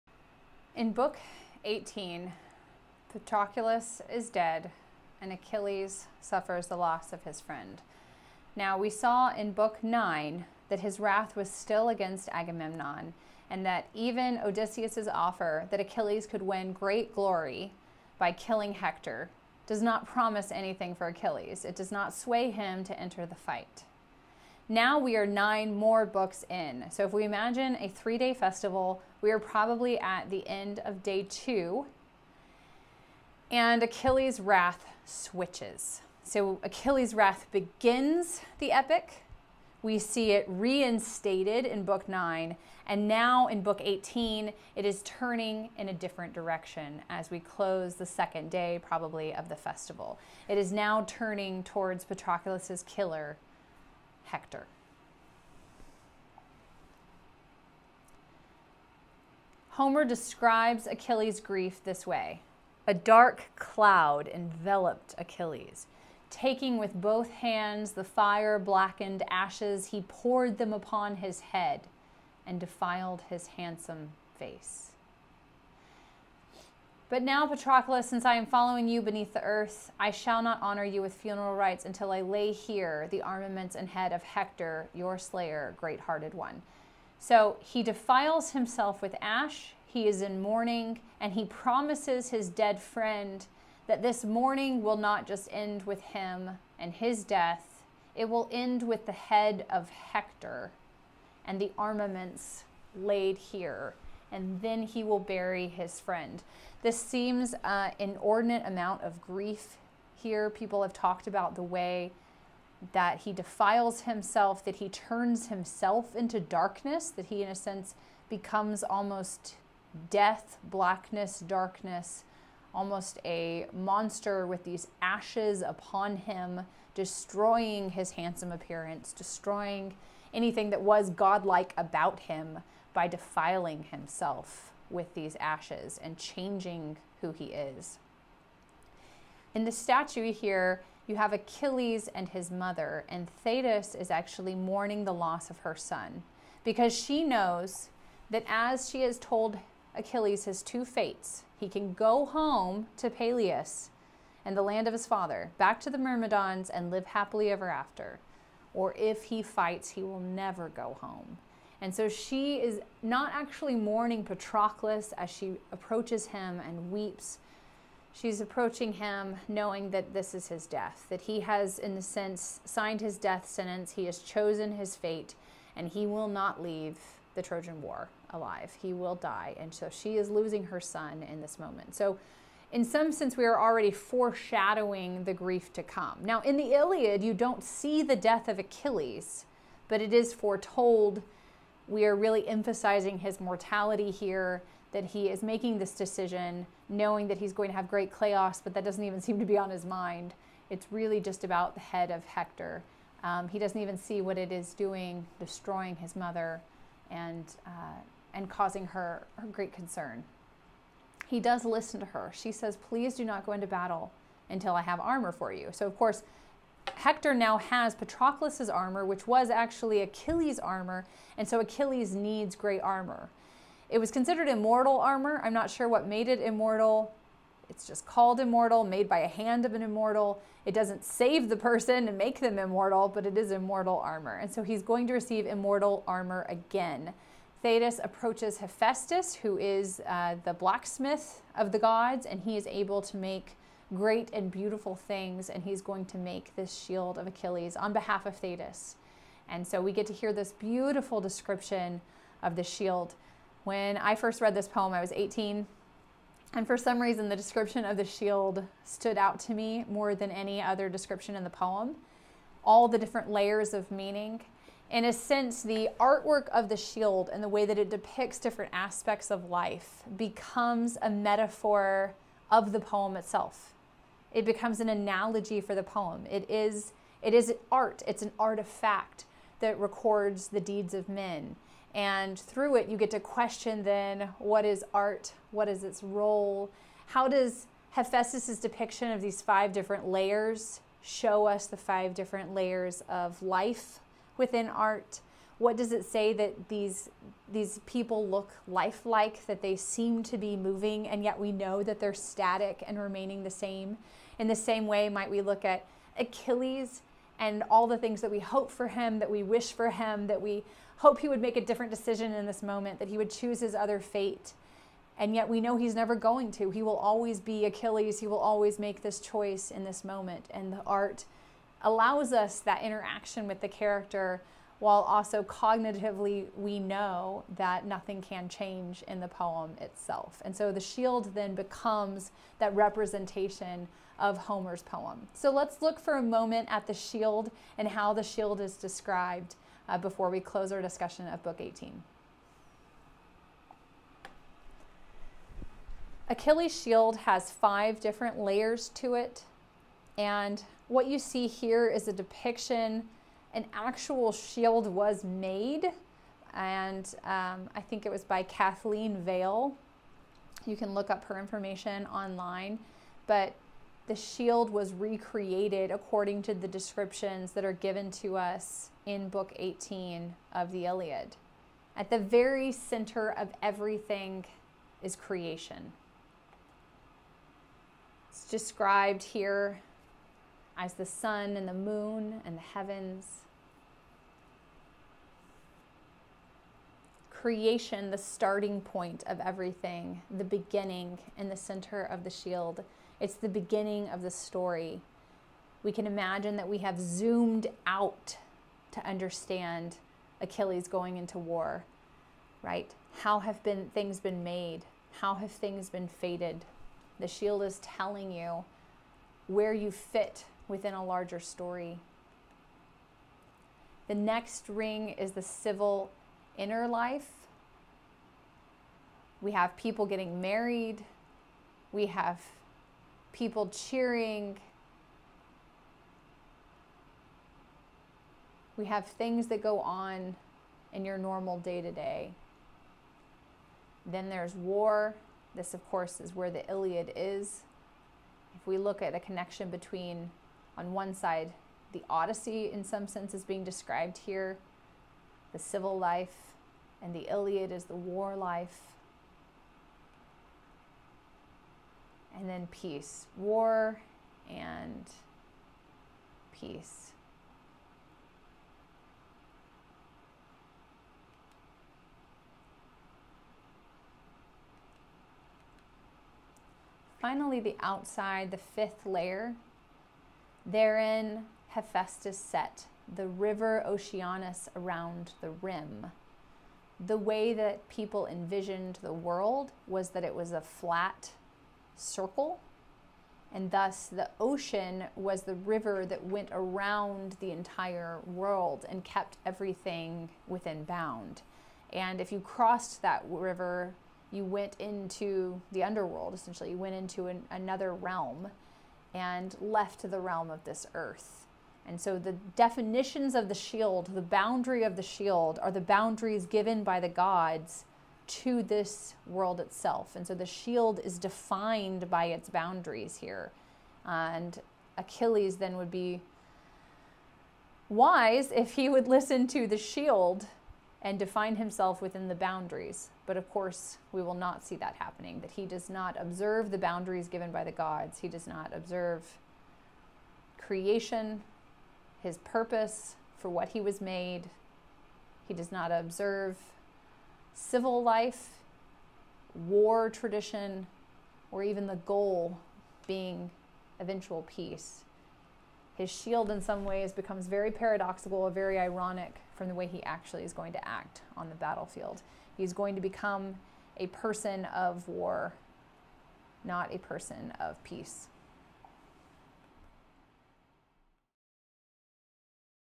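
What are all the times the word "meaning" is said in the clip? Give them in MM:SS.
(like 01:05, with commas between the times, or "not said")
04:23.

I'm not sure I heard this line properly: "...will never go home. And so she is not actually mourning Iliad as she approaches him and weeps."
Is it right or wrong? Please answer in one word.
wrong.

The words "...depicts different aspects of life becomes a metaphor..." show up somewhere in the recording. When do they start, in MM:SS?
04:27.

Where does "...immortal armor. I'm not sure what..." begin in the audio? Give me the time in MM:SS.
03:44.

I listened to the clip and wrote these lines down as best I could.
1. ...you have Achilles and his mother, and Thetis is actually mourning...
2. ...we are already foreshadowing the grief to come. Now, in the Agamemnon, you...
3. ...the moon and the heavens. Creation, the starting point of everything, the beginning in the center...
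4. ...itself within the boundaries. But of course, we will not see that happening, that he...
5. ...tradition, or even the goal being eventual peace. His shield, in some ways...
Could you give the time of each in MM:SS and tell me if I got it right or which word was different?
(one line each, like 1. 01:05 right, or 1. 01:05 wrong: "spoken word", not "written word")
1. 02:21 right
2. 03:03 wrong: "Iliad", not "Agamemnon"
3. 06:21 right
4. 08:41 wrong: "himself", not "itself"
5. 09:00 right.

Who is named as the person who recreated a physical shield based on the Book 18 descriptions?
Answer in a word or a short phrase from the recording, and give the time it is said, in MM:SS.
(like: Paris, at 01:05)
Kathleen Vale, at 05:58.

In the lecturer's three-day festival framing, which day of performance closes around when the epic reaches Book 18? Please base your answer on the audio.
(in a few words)
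day two.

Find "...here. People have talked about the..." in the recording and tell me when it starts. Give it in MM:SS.
01:50.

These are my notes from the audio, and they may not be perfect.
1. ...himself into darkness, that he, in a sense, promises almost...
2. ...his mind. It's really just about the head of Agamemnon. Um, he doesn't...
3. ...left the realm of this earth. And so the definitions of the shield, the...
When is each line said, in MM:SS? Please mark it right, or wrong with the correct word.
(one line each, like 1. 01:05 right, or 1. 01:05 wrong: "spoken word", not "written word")
1. 01:55 wrong: "becomes", not "promises"
2. 03:19 wrong: "Hector", not "Agamemnon"
3. 08:19 right.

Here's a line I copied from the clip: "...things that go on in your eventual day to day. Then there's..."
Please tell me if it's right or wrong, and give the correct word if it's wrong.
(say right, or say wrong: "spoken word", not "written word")
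wrong: "normal", not "eventual".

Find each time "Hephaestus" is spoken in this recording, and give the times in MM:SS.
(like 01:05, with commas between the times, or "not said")
03:58, 04:47, 07:51.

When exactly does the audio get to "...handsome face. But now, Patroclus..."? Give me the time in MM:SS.
01:13.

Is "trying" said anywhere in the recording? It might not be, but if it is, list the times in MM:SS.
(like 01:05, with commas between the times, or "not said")
not said.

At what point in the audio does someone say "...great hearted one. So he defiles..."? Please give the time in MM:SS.
01:25.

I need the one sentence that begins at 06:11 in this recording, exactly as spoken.
At the very center of everything is creation.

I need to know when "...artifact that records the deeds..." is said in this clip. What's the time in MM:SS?
04:38.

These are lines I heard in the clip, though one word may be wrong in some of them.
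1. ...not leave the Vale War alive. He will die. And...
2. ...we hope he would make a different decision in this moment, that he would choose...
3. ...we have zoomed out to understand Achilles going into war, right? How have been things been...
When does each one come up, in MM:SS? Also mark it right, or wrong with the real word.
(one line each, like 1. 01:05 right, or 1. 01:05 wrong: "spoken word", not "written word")
1. 02:56 wrong: "Trojan", not "Vale"
2. 05:10 right
3. 06:36 right.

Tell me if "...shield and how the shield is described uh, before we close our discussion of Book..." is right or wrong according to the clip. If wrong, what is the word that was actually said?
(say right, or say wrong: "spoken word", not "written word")
right.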